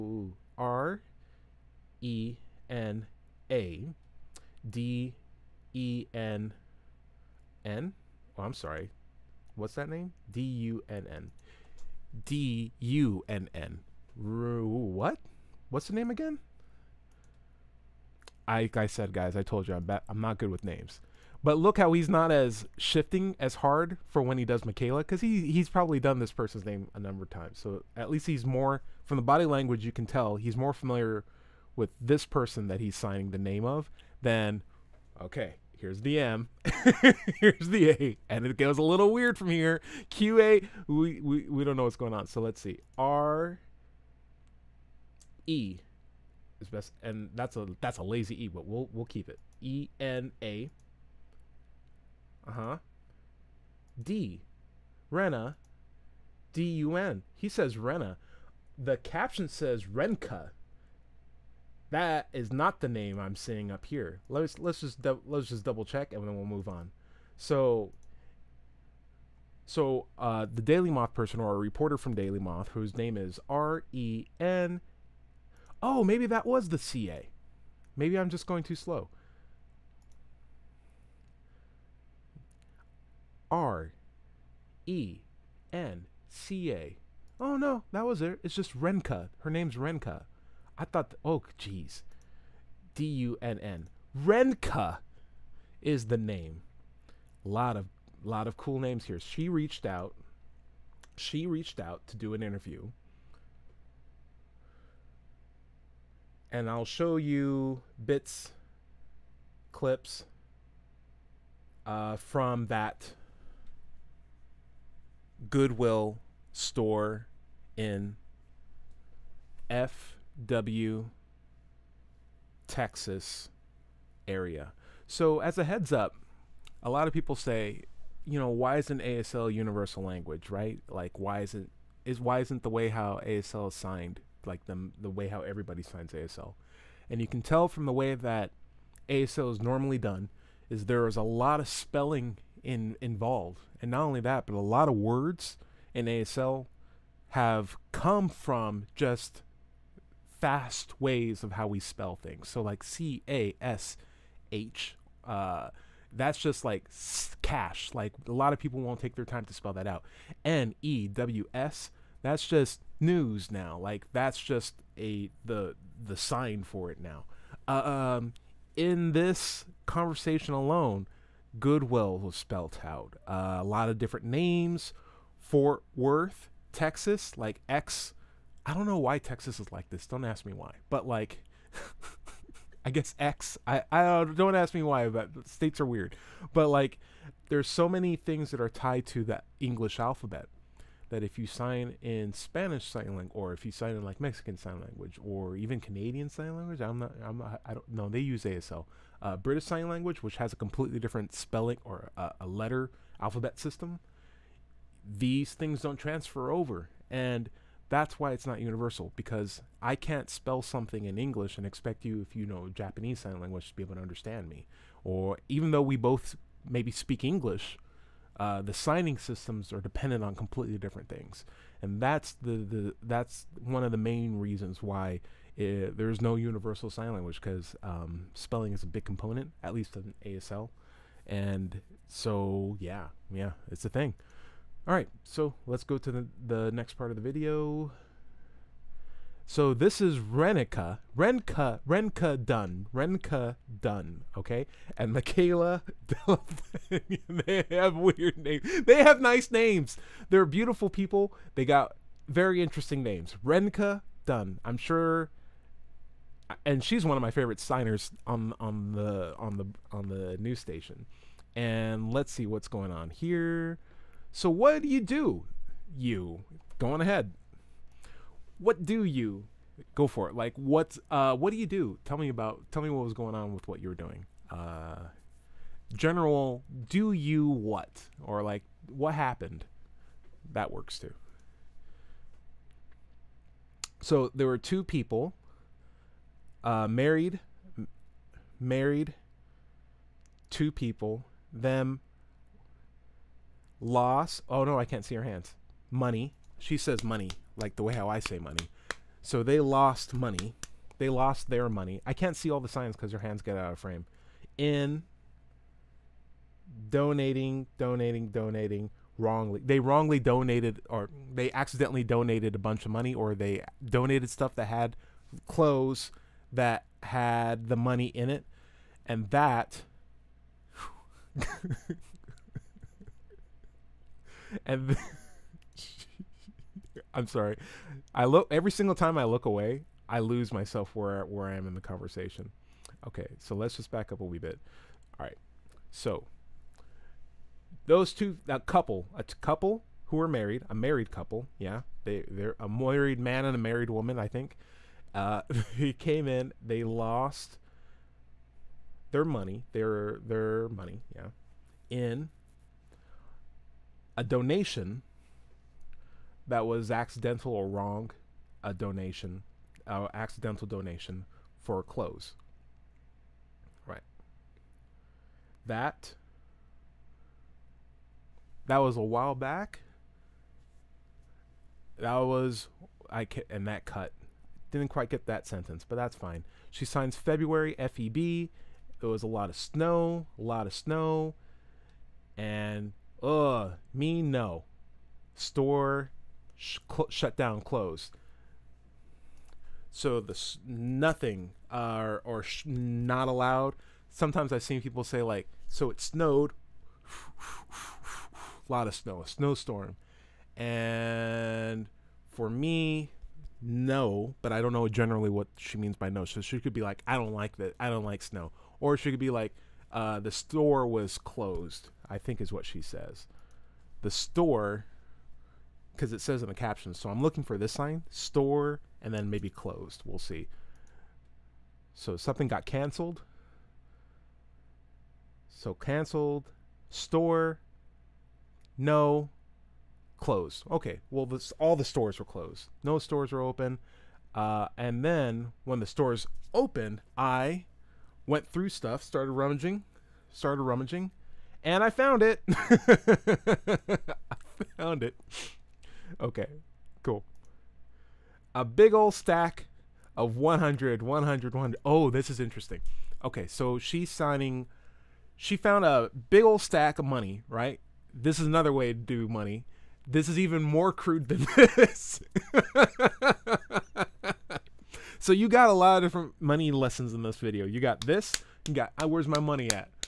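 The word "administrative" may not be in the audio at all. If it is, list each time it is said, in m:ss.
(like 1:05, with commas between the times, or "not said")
not said.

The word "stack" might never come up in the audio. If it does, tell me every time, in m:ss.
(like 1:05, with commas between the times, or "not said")
7:29, 7:36.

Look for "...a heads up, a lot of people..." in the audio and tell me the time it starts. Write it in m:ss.
2:05.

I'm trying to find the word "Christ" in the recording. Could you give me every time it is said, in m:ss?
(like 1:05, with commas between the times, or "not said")
not said.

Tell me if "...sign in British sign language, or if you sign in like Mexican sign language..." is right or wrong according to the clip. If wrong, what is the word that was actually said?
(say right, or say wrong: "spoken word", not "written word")
wrong: "Spanish", not "British".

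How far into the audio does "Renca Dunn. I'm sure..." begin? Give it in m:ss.
4:13.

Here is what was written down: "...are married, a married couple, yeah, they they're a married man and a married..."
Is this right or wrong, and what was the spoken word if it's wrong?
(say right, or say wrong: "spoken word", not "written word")
right.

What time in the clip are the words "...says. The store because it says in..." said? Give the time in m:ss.
6:52.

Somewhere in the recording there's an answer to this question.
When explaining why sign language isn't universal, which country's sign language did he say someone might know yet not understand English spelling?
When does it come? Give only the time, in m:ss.
3:32.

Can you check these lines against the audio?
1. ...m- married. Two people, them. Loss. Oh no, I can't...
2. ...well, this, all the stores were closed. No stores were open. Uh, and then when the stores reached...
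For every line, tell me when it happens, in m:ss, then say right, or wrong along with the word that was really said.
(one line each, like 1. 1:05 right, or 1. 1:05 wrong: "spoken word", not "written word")
1. 4:47 right
2. 7:11 wrong: "opened", not "reached".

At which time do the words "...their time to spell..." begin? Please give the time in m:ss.
2:39.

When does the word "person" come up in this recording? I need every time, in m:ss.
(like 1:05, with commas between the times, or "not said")
0:26, 0:32, 1:11.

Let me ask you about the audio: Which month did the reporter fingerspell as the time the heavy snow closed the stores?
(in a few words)
February.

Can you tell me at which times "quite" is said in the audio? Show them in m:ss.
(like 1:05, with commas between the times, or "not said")
6:14.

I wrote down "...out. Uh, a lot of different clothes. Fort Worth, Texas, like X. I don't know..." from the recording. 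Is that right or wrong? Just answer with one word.
wrong.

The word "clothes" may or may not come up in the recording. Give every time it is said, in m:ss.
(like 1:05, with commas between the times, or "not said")
5:15, 6:01.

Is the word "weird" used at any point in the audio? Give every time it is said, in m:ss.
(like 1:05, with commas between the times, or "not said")
0:39, 3:05, 4:07.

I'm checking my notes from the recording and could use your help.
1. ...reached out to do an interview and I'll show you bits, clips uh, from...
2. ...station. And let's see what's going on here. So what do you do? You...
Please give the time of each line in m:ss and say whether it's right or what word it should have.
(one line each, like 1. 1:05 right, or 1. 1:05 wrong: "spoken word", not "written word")
1. 1:41 right
2. 4:20 right.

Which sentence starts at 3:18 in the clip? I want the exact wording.
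They use ASL, uh, British sign language, which has a completely different spelling or a, a letter alphabet system.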